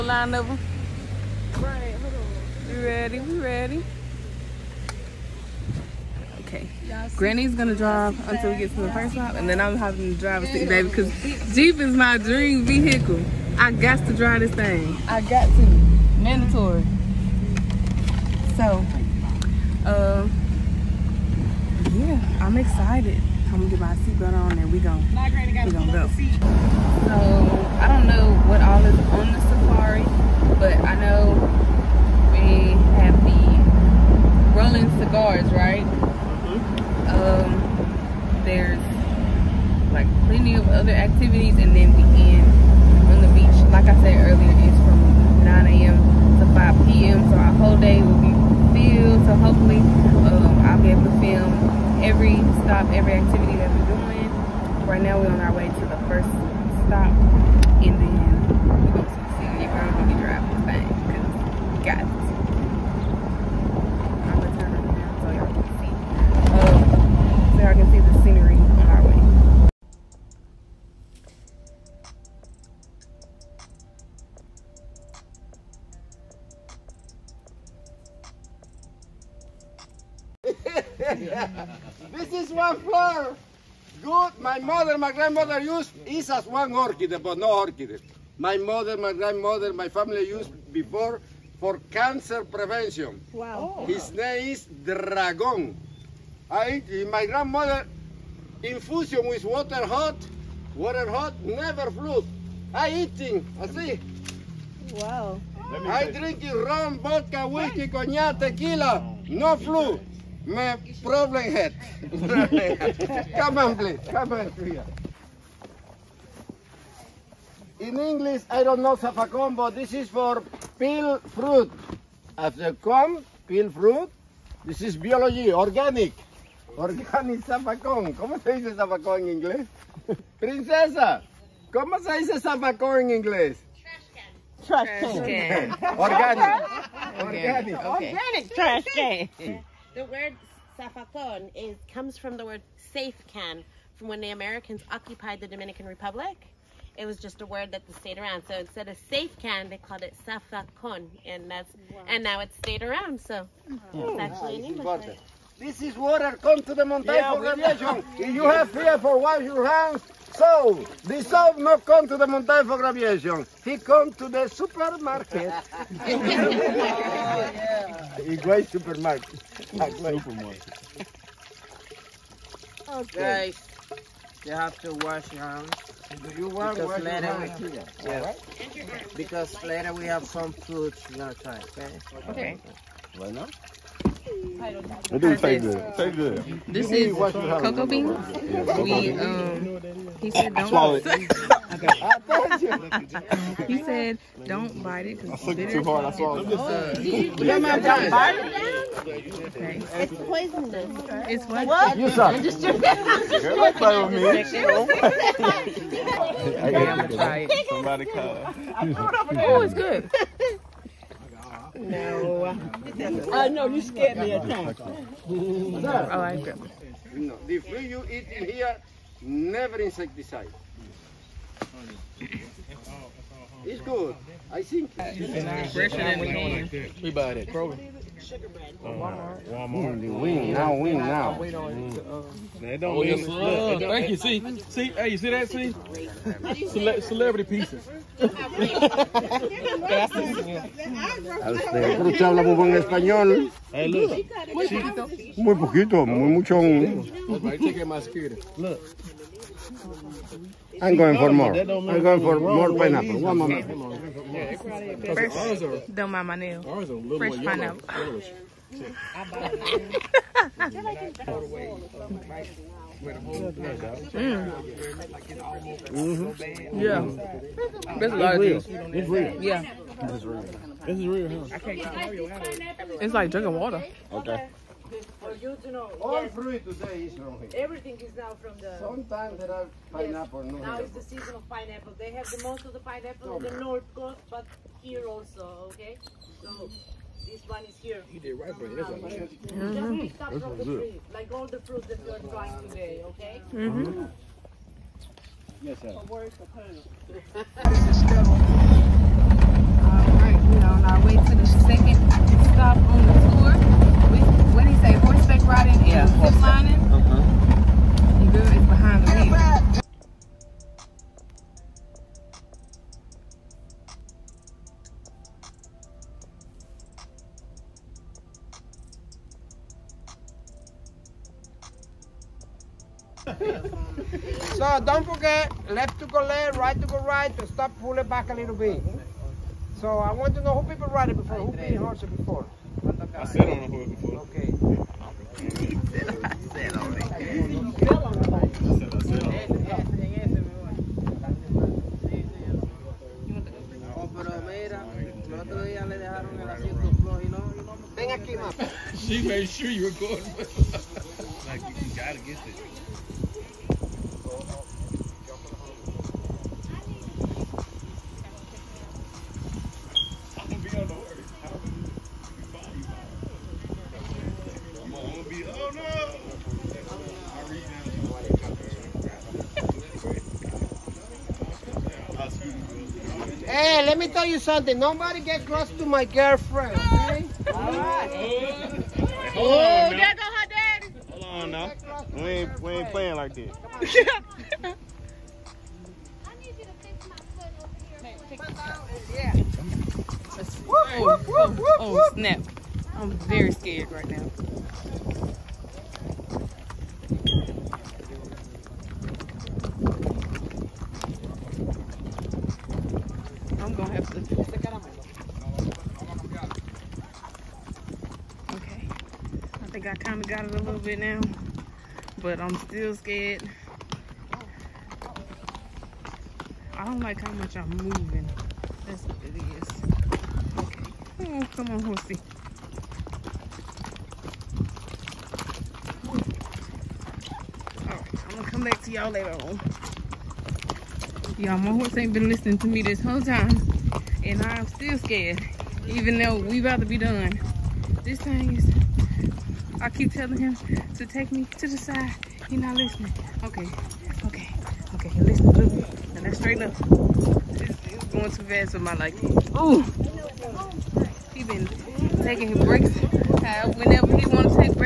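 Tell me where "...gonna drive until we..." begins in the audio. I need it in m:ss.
0:07.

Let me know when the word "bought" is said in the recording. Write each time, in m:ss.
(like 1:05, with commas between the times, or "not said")
3:47.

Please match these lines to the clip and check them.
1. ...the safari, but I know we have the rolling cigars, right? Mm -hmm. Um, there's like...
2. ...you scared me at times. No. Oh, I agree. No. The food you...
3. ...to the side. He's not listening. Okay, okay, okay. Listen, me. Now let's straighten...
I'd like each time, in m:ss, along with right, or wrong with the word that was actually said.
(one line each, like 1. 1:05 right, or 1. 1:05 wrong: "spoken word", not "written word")
1. 0:29 right
2. 3:33 right
3. 7:21 right.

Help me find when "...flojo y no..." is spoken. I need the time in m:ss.
5:47.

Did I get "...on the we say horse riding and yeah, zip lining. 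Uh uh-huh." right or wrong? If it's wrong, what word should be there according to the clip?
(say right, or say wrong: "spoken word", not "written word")
right.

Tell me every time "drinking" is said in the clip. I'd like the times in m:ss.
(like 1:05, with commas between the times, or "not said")
1:46, 4:33.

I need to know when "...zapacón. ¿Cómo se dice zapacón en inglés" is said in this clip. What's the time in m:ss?
2:07.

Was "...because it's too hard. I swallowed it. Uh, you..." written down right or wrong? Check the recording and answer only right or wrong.
right.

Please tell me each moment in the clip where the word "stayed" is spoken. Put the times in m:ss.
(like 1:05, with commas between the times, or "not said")
2:27, 2:32.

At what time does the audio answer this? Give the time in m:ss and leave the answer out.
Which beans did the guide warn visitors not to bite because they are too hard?
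3:07.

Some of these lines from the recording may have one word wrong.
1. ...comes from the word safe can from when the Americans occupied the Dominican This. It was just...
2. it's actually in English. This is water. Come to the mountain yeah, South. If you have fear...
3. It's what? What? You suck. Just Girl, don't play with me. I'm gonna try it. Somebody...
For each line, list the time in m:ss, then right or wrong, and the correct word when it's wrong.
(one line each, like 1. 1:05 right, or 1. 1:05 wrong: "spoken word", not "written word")
1. 2:21 wrong: "Republic", not "This"
2. 2:33 wrong: "Formation", not "South"
3. 3:21 right.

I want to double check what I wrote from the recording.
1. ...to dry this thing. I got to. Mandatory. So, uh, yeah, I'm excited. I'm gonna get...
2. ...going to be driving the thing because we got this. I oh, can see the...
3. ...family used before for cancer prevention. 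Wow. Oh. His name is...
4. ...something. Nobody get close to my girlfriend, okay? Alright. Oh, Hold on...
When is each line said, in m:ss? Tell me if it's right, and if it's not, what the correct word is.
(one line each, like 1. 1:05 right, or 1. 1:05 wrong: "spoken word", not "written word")
1. 0:14 right
2. 0:59 right
3. 1:29 right
4. 6:14 right.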